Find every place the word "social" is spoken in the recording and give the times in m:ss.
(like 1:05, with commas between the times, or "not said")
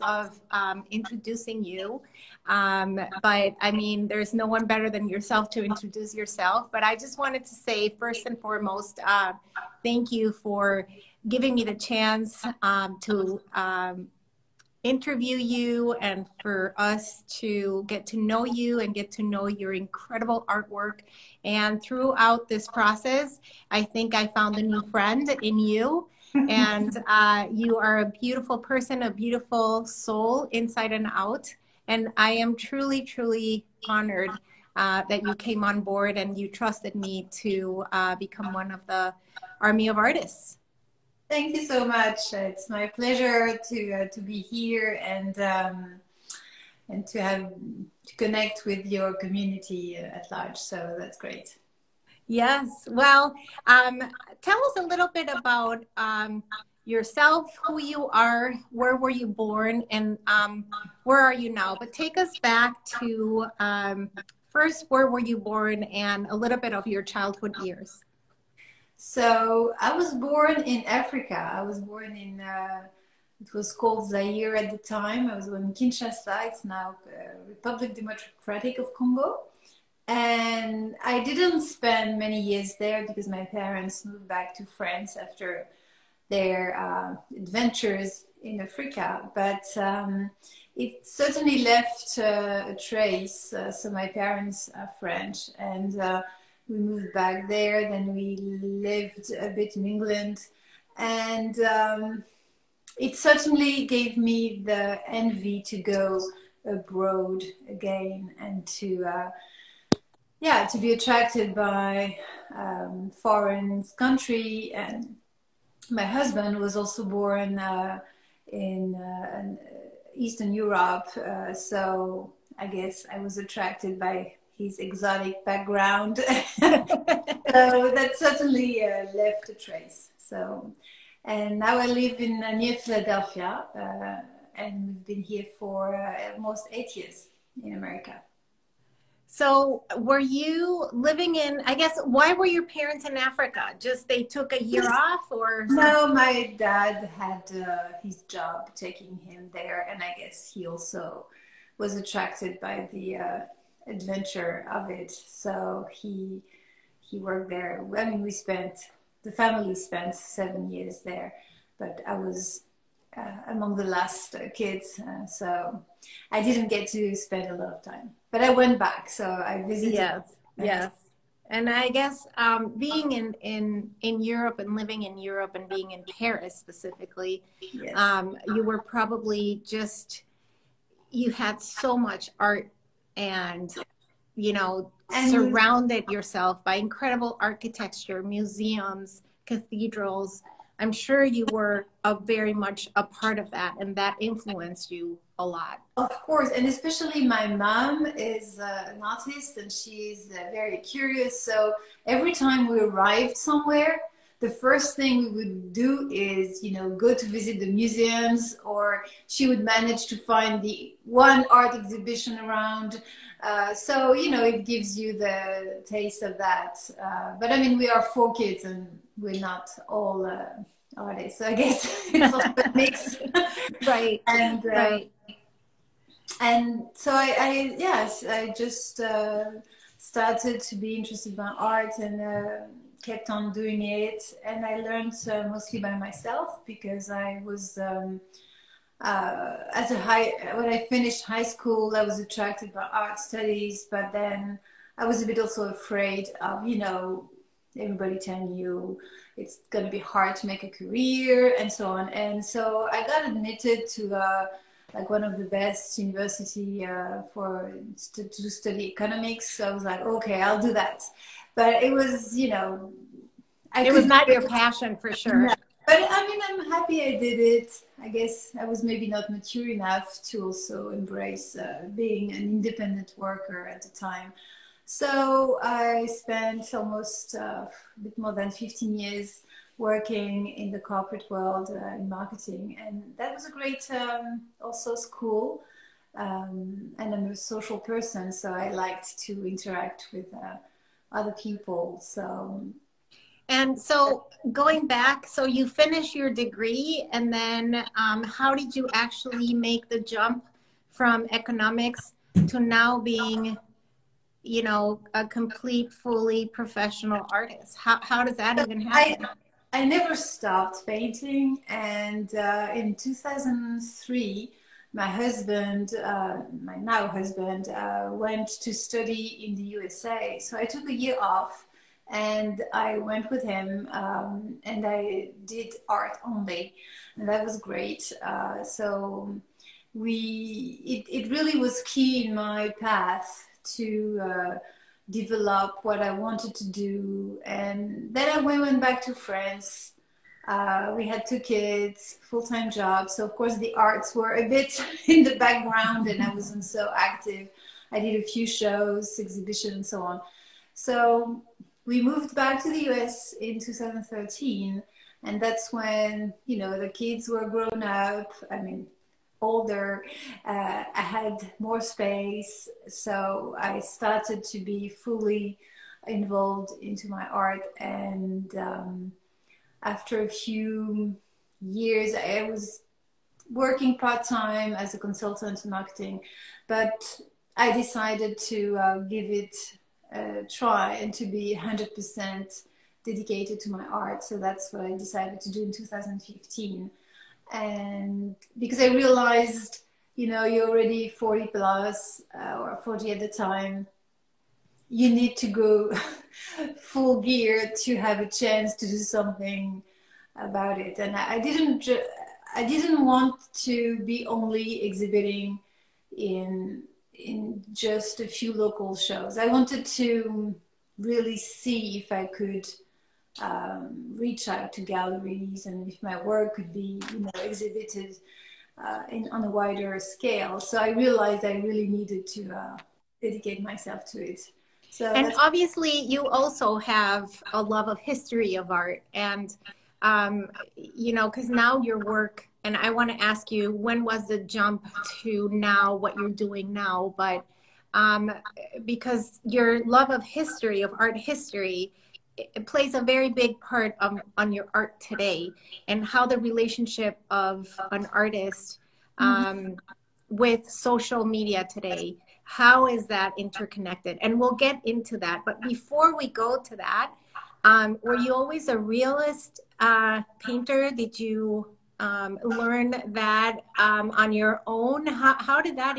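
4:47, 7:30.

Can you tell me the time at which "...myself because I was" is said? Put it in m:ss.
3:55.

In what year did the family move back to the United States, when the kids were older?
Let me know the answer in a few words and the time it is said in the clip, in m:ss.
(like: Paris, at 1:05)
2013, at 5:53.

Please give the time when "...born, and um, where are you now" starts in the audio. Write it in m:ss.
0:59.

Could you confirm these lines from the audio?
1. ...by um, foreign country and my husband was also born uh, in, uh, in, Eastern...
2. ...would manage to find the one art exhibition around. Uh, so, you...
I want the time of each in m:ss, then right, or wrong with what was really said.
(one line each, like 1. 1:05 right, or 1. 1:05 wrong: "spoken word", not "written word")
1. 1:51 right
2. 3:29 right.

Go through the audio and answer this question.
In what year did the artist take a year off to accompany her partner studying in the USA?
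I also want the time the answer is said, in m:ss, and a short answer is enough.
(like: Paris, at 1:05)
2003, at 5:12.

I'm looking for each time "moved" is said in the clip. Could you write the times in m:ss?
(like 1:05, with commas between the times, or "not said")
1:24, 1:36, 5:52.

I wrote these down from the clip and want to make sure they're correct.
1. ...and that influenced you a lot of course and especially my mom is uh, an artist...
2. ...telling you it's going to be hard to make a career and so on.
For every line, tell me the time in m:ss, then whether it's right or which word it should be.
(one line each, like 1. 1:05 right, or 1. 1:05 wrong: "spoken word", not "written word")
1. 3:13 right
2. 4:08 right.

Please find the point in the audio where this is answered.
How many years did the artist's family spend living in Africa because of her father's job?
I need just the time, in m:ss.
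2:40.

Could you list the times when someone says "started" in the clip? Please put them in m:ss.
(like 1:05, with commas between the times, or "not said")
3:49, 6:03.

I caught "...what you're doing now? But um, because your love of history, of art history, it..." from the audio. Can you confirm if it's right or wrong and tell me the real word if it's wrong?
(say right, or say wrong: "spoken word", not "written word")
right.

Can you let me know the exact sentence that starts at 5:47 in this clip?
I did a few shows, exhibitions, and so on.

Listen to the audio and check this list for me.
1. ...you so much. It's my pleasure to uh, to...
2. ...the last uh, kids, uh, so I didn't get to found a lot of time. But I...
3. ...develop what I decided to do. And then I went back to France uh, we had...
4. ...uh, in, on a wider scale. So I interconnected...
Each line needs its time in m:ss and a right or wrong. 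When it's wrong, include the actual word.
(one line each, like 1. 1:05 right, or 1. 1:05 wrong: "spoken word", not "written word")
1. 0:41 right
2. 2:43 wrong: "spend", not "found"
3. 5:35 wrong: "wanted", not "decided"
4. 6:58 wrong: "realized", not "interconnected".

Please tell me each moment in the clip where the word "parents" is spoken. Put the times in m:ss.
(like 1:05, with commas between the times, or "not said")
1:23, 1:34, 2:22.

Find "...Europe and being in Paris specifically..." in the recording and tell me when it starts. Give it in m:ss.
2:55.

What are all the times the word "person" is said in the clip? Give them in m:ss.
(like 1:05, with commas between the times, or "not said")
0:28, 4:47.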